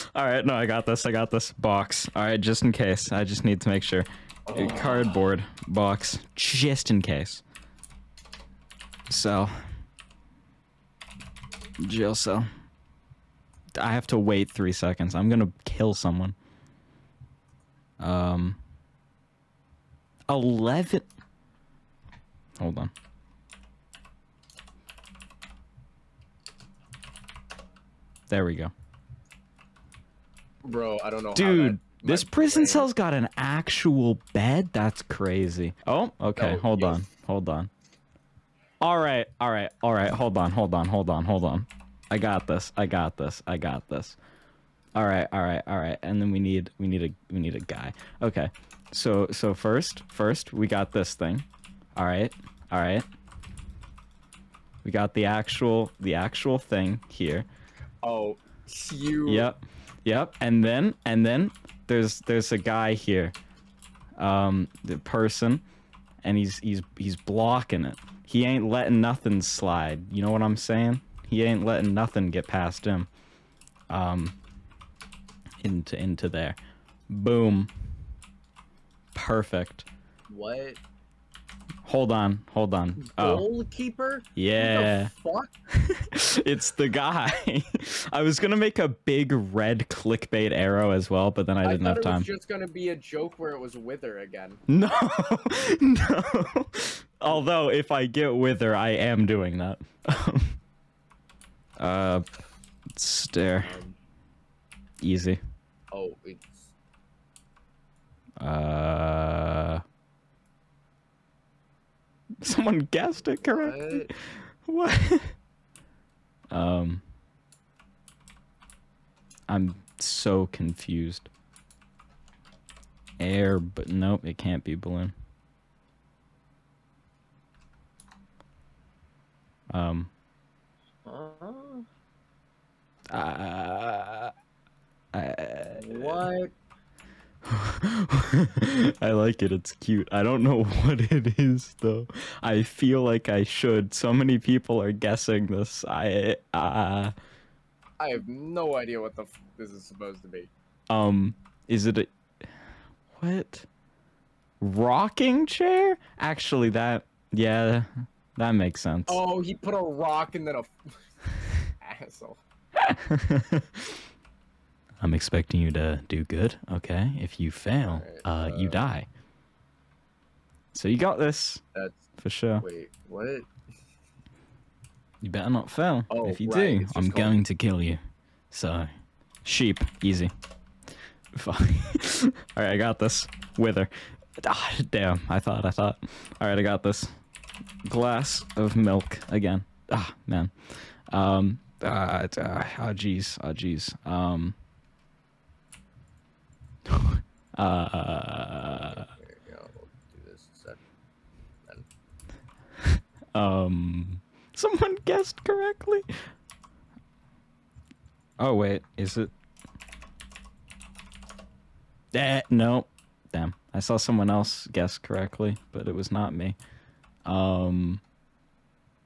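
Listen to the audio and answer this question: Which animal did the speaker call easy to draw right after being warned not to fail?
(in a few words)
sheep.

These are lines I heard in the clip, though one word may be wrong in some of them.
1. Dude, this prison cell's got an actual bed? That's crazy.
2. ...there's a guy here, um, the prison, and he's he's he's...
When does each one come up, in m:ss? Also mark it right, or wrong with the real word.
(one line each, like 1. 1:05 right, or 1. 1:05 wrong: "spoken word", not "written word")
1. 0:31 right
2. 1:02 wrong: "person", not "prison".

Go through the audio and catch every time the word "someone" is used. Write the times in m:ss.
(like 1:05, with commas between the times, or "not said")
0:15, 1:52, 3:24, 3:33.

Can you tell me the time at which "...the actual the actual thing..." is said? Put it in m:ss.
0:55.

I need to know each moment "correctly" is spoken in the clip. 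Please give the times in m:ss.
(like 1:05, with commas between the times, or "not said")
1:53, 3:25, 3:34.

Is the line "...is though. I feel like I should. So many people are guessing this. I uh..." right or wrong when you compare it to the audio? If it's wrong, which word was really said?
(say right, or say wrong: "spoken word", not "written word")
right.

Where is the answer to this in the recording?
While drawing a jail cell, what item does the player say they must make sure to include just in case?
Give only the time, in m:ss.
0:04.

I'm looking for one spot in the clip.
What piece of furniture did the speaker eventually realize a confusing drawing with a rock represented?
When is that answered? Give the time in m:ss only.
2:34.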